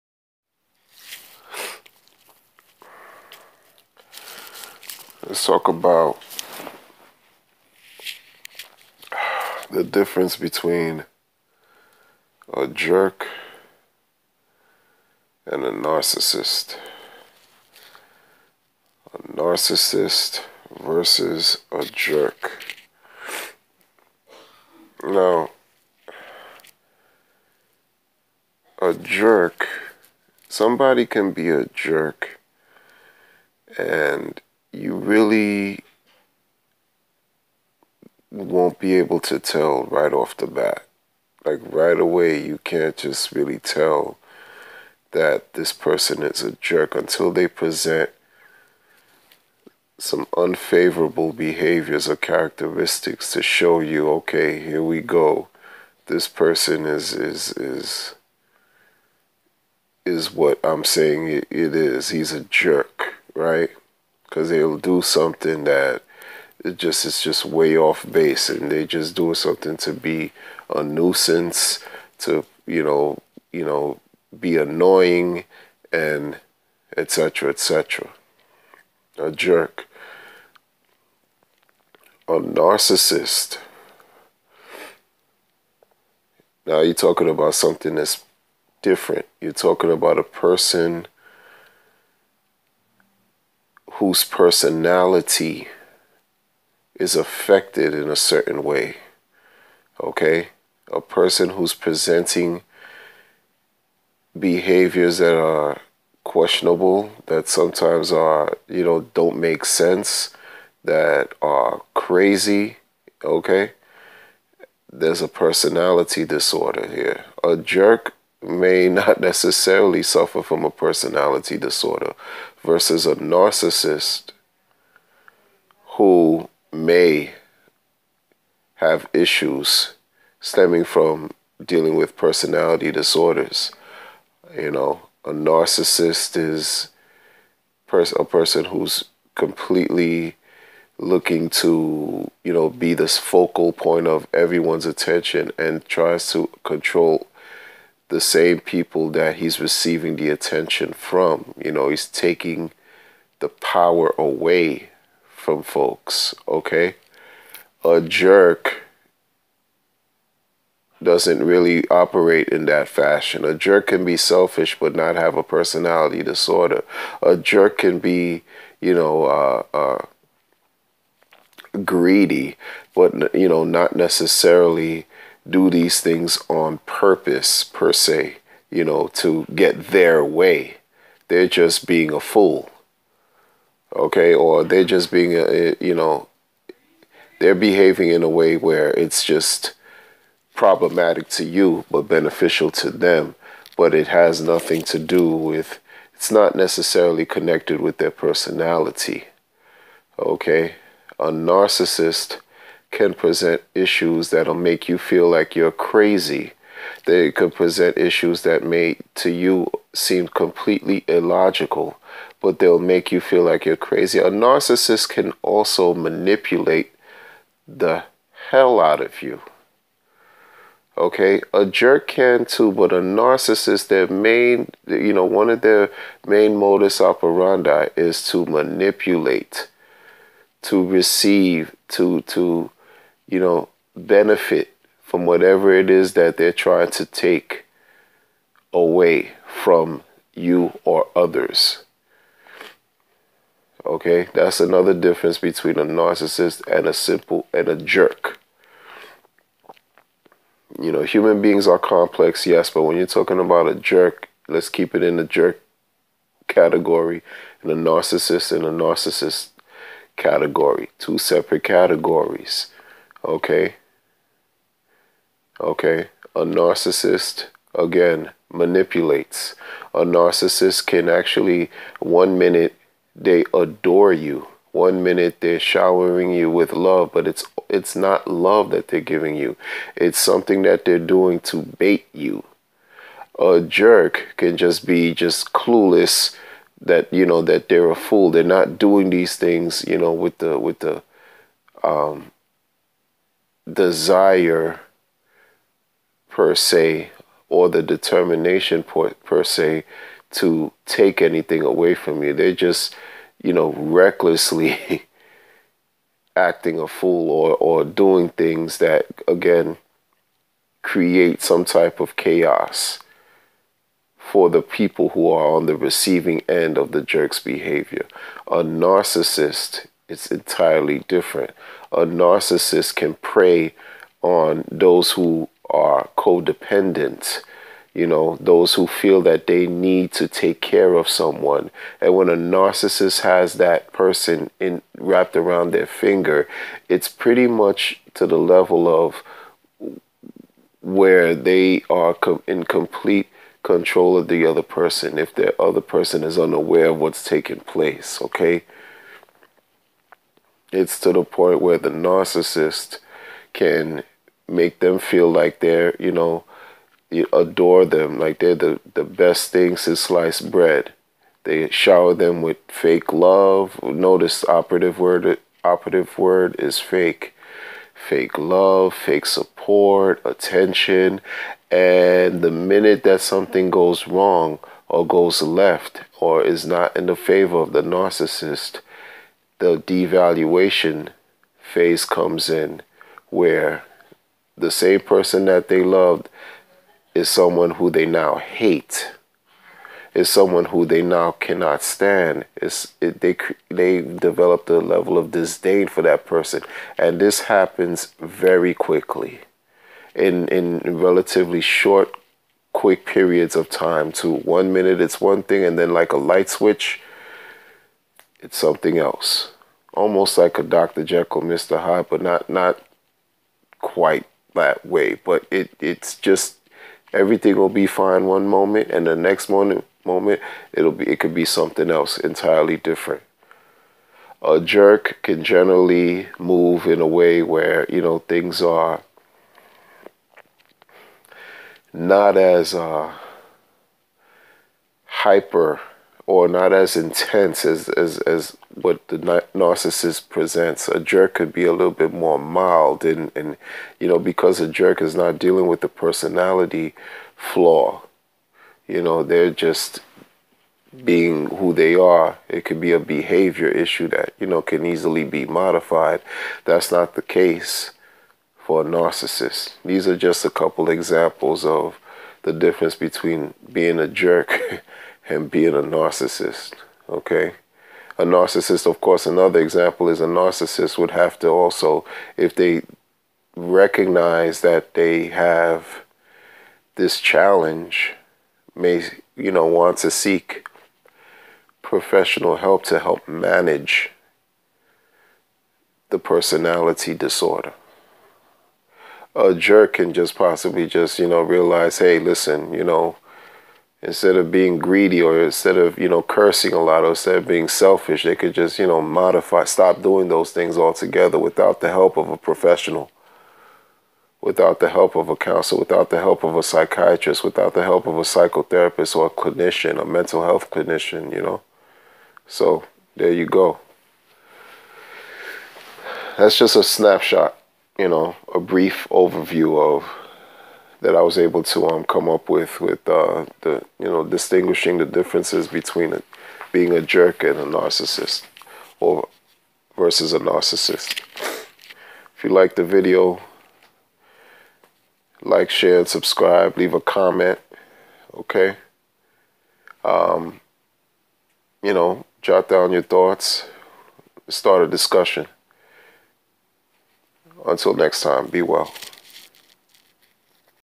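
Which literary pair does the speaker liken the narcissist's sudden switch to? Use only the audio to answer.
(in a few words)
Dr. Jekyll, Mr. Hyde.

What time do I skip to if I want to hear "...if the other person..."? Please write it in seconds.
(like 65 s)
345 s.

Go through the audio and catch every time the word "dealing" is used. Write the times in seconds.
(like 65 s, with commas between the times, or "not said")
131 s, 445 s.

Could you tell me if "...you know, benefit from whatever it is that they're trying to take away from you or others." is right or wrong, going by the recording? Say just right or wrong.
right.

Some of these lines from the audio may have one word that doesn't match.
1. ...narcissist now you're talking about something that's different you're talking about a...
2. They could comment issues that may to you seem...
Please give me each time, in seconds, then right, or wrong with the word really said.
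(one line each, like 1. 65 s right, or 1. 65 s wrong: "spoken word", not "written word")
1. 82 s right
2. 207 s wrong: "present", not "comment".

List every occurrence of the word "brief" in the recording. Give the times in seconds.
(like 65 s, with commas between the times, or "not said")
518 s.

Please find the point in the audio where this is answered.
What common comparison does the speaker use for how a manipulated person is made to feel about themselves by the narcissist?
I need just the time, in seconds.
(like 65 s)
359 s.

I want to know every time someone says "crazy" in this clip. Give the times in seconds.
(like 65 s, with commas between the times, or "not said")
111 s, 205 s, 213 s.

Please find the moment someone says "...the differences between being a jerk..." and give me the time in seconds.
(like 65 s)
524 s.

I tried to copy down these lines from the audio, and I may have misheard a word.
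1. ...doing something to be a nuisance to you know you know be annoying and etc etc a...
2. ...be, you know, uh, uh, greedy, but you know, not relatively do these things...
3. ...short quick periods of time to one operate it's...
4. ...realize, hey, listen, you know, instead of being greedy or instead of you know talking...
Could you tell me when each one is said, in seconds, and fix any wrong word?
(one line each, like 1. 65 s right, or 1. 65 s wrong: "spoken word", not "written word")
1. 69 s right
2. 167 s wrong: "necessarily", not "relatively"
3. 401 s wrong: "minute", not "operate"
4. 491 s wrong: "cursing", not "talking".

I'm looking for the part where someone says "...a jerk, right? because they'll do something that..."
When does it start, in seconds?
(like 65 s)
62 s.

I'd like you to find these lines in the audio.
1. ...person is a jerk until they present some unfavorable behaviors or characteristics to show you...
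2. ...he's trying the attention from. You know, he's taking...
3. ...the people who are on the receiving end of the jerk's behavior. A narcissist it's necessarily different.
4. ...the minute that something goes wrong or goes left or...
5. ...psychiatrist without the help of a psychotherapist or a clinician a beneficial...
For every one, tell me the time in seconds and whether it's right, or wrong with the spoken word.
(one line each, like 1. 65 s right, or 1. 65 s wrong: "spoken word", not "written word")
1. 45 s right
2. 149 s wrong: "receiving", not "trying"
3. 314 s wrong: "entirely", not "necessarily"
4. 372 s right
5. 506 s wrong: "mental", not "beneficial".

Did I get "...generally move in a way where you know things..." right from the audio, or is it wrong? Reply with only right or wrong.
right.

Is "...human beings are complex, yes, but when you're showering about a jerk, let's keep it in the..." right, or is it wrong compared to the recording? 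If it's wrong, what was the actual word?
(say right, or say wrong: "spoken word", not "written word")
wrong: "talking", not "showering".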